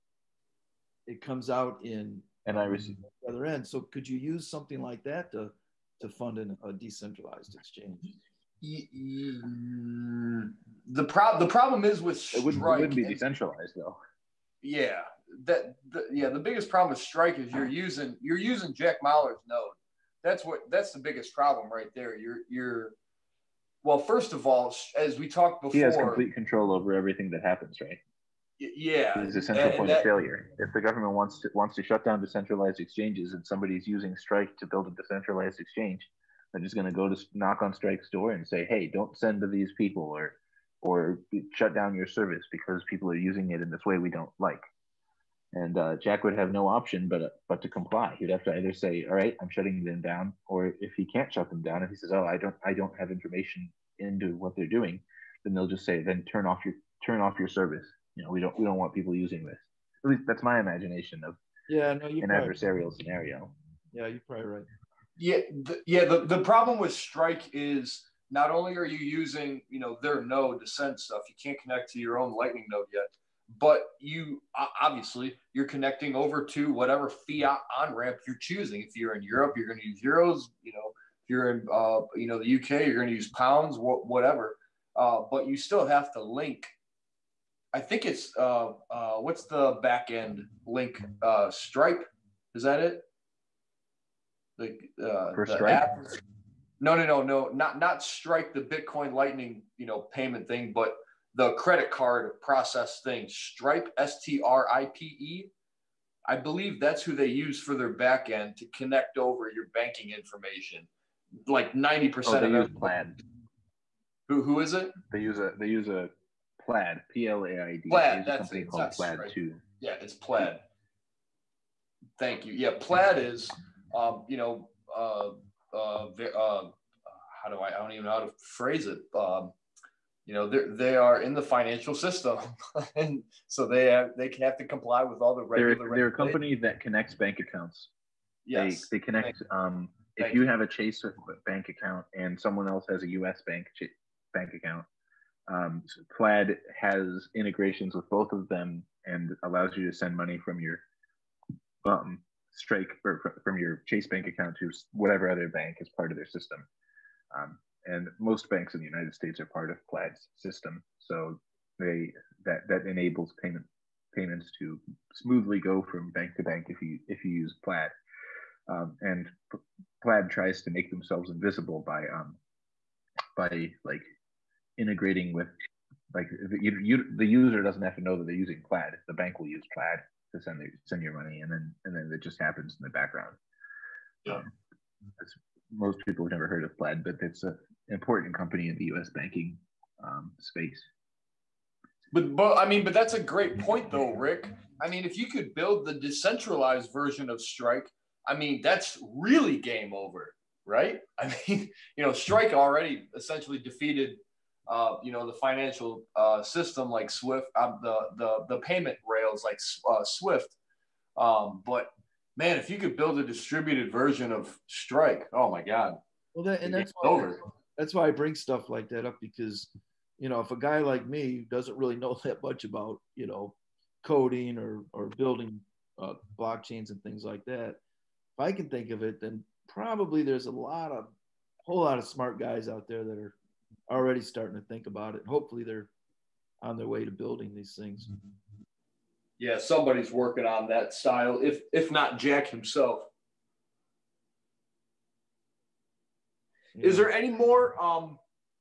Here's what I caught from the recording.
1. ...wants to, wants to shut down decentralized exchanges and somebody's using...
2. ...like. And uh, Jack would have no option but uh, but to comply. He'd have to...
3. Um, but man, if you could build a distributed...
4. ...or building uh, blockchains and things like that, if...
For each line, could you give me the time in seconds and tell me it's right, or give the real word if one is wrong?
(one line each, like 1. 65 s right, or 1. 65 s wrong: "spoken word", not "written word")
1. 31 s right
2. 44 s right
3. 211 s right
4. 224 s right.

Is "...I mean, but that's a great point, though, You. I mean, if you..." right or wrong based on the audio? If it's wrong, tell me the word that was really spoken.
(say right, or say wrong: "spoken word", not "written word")
wrong: "Rick", not "You".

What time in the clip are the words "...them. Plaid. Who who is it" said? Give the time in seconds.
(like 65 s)
112 s.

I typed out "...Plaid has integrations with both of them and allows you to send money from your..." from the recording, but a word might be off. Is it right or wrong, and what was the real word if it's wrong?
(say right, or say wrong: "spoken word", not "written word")
right.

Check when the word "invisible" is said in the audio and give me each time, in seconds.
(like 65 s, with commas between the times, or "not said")
171 s.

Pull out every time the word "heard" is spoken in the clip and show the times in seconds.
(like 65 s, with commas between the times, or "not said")
186 s.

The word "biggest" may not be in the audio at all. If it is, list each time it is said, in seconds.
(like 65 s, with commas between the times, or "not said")
16 s, 20 s.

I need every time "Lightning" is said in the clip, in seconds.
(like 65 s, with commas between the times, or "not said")
72 s, 99 s.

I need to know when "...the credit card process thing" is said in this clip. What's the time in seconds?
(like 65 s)
101 s.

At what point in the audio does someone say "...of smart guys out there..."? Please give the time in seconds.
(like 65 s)
231 s.